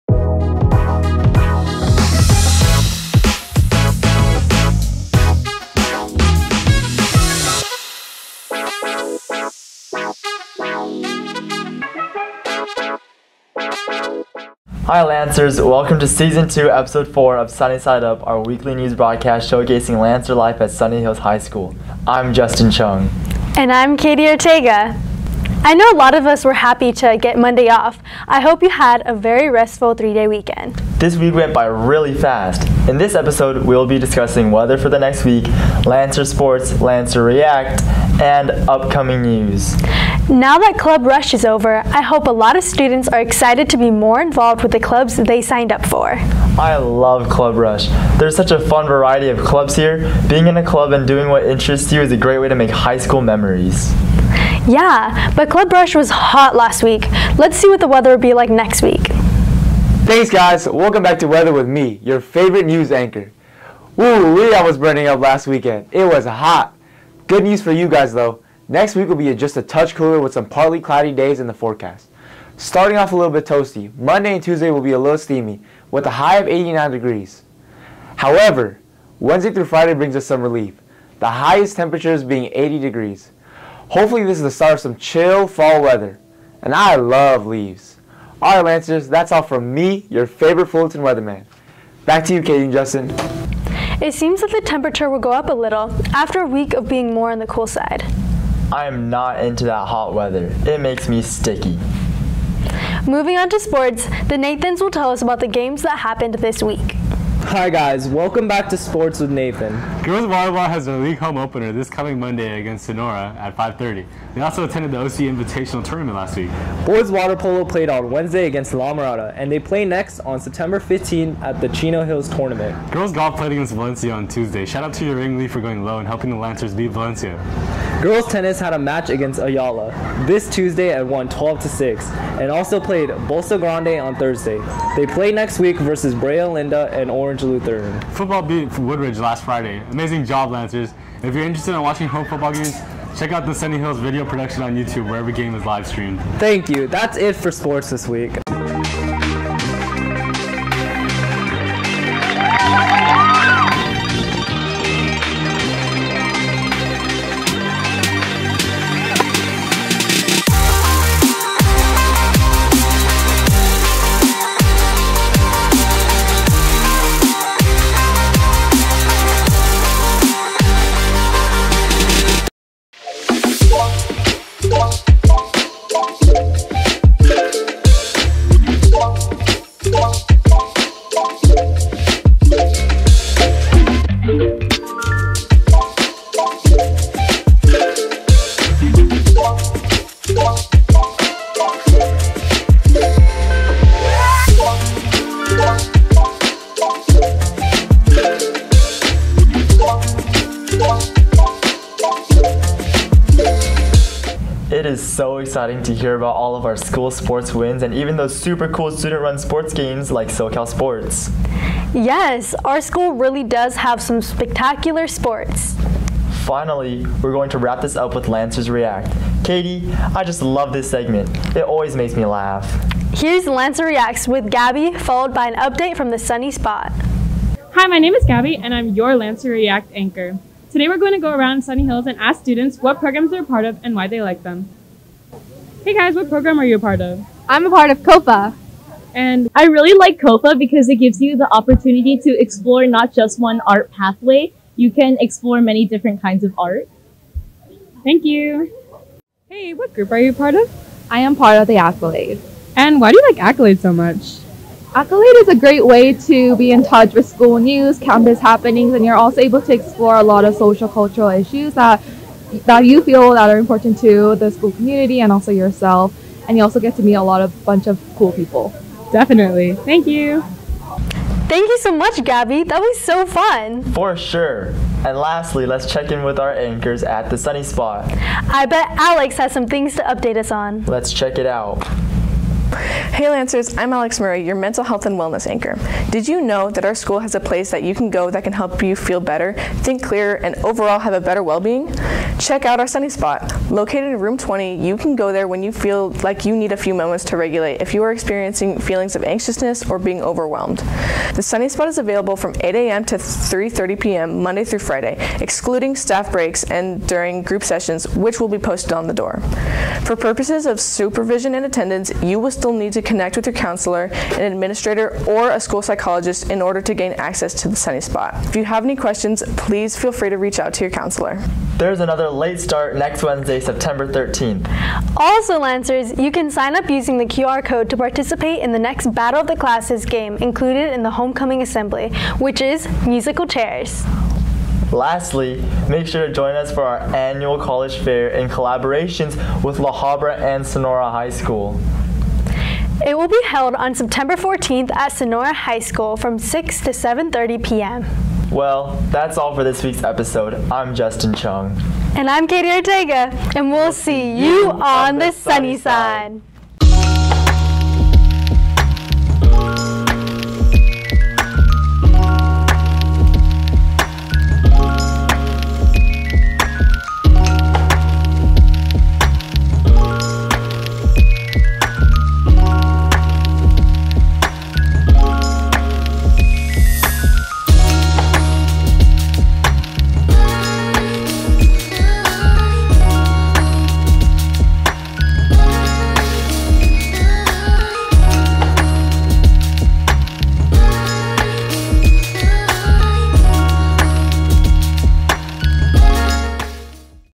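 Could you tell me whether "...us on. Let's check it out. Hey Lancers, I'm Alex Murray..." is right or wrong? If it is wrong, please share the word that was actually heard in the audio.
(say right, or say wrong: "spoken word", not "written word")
right.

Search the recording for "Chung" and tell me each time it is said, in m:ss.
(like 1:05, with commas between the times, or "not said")
0:22, 5:51.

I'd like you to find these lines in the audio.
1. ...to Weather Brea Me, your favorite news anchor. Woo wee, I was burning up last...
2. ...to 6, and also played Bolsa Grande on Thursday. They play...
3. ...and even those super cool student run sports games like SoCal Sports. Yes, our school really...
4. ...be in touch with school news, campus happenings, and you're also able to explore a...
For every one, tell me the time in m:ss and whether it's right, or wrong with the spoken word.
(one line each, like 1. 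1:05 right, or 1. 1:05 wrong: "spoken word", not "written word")
1. 1:01 wrong: "With", not "Brea"
2. 2:11 right
3. 3:27 right
4. 4:16 right.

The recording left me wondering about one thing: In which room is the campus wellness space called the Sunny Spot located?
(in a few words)
Room 20.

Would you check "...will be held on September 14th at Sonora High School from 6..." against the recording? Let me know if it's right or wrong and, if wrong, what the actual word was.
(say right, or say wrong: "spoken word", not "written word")
right.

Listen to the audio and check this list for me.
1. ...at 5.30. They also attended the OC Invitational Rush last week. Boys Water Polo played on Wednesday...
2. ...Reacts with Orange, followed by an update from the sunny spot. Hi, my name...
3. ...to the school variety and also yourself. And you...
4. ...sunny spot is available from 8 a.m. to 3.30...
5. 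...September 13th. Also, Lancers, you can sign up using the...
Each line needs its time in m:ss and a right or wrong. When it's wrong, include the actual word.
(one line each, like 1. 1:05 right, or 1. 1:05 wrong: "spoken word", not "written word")
1. 1:53 wrong: "Tournament", not "Rush"
2. 3:43 wrong: "Gabby", not "Orange"
3. 4:23 wrong: "community", not "variety"
4. 5:01 right
5. 5:23 right.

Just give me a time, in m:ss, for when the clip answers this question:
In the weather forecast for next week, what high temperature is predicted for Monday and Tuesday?
1:16.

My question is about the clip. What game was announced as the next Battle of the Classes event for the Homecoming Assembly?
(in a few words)
Musical chairs.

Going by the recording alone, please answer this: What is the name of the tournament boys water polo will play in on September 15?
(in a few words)
Chino Hills Tournament.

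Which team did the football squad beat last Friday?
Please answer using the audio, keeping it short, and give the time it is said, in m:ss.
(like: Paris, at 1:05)
Woodbridge, at 2:18.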